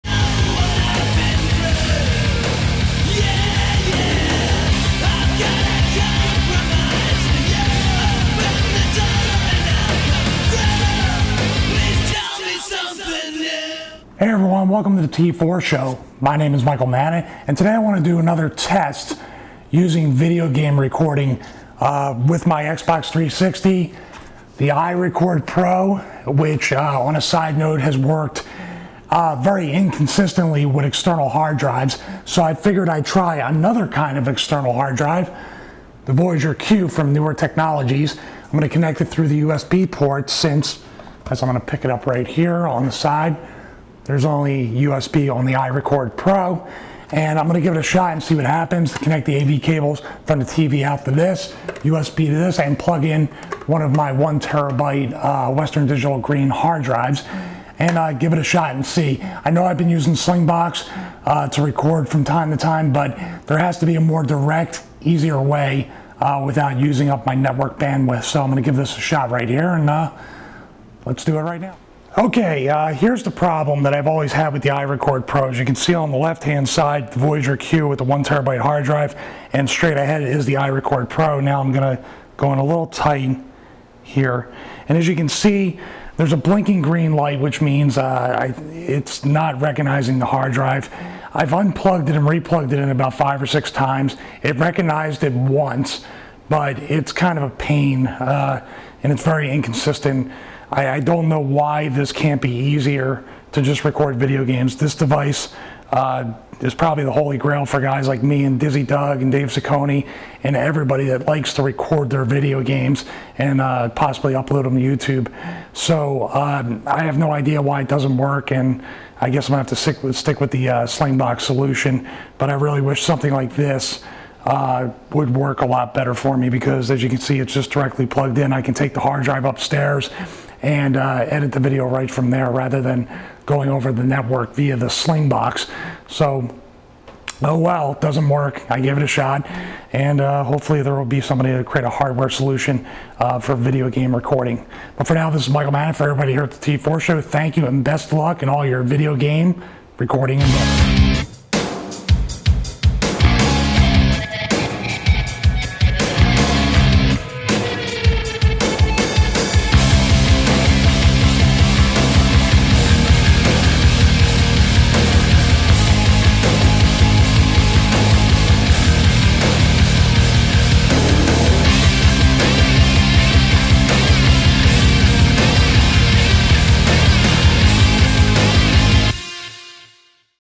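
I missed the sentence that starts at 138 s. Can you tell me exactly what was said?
I gave it a shot, and uh, hopefully there will be somebody to create a hardware solution uh, for video game recording.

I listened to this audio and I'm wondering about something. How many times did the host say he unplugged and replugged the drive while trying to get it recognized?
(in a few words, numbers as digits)
5 or 6.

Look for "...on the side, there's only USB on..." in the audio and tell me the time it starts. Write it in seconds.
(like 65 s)
42 s.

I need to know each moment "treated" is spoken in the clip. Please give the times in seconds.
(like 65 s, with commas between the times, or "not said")
not said.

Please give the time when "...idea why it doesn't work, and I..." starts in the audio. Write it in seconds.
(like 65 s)
117 s.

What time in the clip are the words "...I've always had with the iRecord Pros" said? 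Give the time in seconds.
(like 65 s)
73 s.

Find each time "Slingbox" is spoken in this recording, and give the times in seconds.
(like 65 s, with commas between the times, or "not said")
60 s, 120 s, 134 s.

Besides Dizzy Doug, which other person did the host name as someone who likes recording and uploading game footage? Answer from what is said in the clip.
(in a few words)
Dave Ciccone.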